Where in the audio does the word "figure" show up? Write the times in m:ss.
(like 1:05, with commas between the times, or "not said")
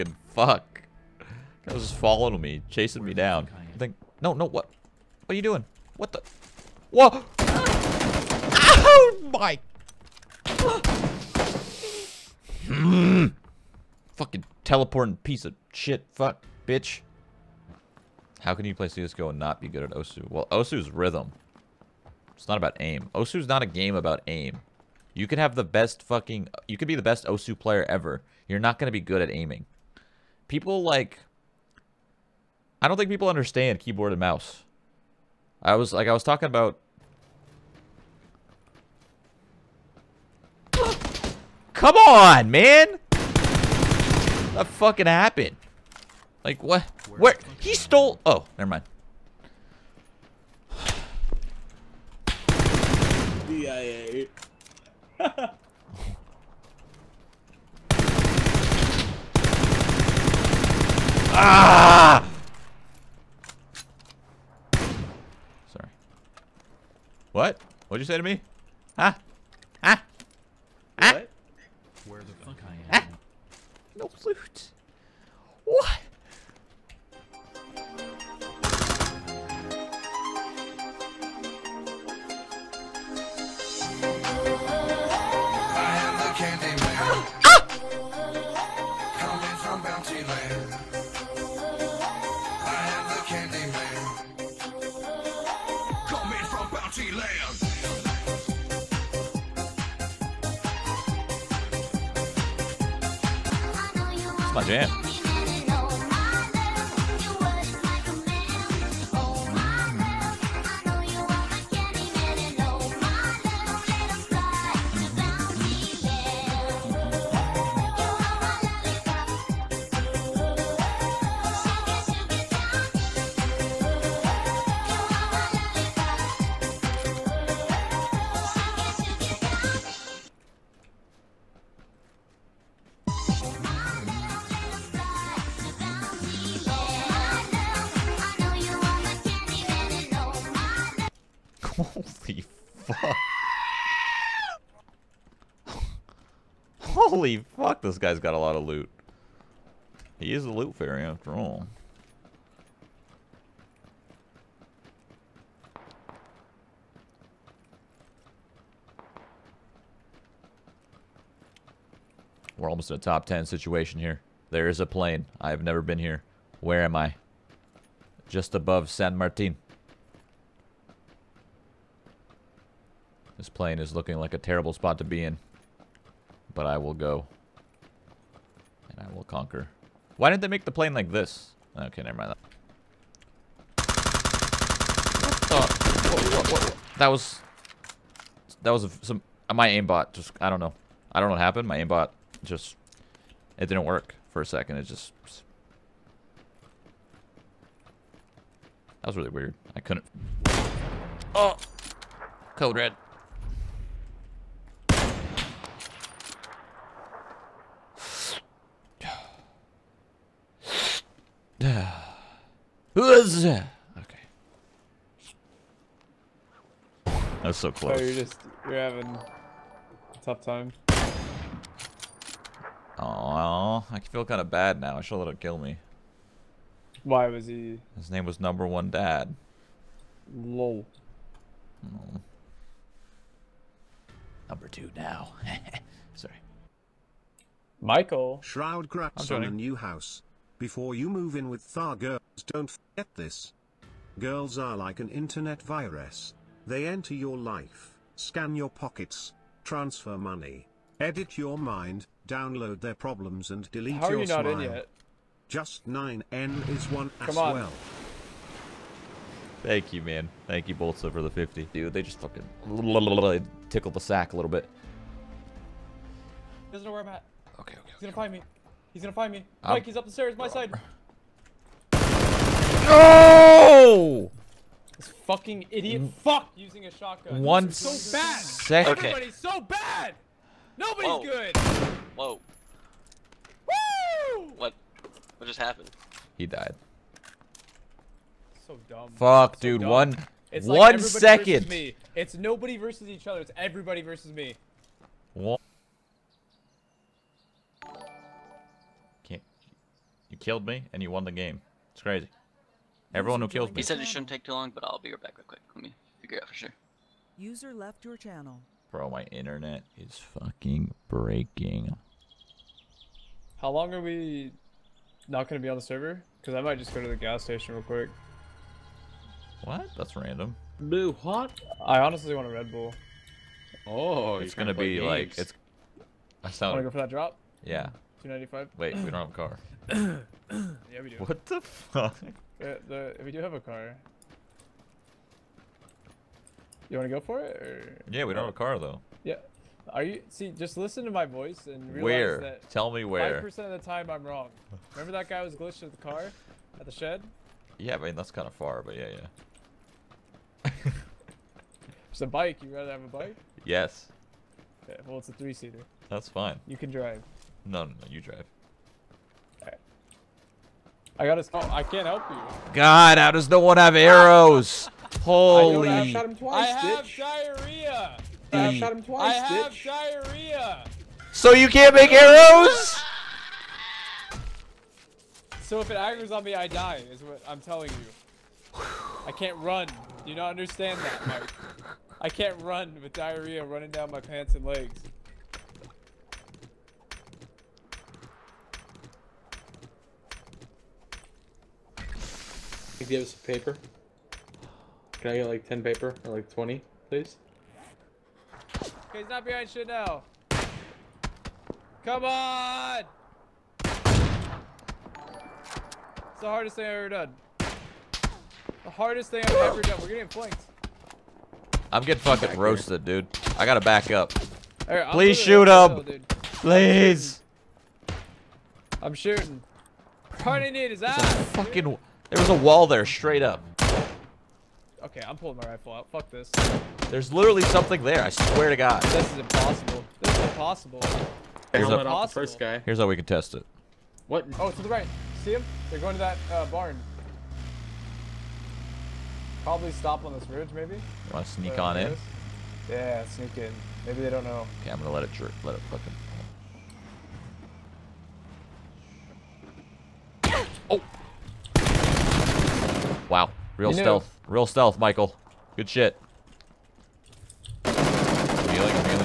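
5:06.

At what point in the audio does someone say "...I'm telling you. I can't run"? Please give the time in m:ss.
6:17.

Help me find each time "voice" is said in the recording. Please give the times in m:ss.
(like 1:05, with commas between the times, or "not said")
5:41.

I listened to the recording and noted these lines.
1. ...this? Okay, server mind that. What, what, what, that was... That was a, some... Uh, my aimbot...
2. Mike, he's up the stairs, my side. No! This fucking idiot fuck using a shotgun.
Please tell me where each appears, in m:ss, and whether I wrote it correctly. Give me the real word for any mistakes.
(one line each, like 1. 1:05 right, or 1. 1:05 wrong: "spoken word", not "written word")
1. 3:01 wrong: "never", not "server"
2. 4:29 right.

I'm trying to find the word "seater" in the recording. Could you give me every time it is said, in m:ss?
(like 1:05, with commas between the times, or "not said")
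5:55.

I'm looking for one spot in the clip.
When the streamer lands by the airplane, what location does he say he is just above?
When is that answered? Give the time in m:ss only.
2:48.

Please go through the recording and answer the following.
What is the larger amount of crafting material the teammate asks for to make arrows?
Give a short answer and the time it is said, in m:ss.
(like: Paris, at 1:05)
20, at 6:36.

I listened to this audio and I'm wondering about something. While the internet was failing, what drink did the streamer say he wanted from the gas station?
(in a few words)
Red Bull.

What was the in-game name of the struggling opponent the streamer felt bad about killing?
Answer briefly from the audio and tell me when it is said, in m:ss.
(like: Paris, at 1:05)
Number One Dad, at 3:48.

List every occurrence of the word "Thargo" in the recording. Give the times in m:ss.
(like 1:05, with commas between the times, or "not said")
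4:01.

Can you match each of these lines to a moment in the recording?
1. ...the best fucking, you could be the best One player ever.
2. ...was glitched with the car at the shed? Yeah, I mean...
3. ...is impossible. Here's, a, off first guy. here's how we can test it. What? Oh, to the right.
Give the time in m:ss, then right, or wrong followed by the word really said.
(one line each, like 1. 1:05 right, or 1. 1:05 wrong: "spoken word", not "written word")
1. 0:25 wrong: "Osu", not "One"
2. 5:45 right
3. 7:10 right.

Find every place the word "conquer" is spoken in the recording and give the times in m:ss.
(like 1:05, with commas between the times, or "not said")
2:59.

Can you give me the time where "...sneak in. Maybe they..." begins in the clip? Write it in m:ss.
7:23.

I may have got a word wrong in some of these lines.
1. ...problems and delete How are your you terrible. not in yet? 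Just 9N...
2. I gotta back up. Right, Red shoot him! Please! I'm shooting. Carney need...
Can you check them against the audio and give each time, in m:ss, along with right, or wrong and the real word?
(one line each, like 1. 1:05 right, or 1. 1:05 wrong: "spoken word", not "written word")
1. 4:12 wrong: "smile", not "terrible"
2. 6:53 wrong: "Please", not "Red".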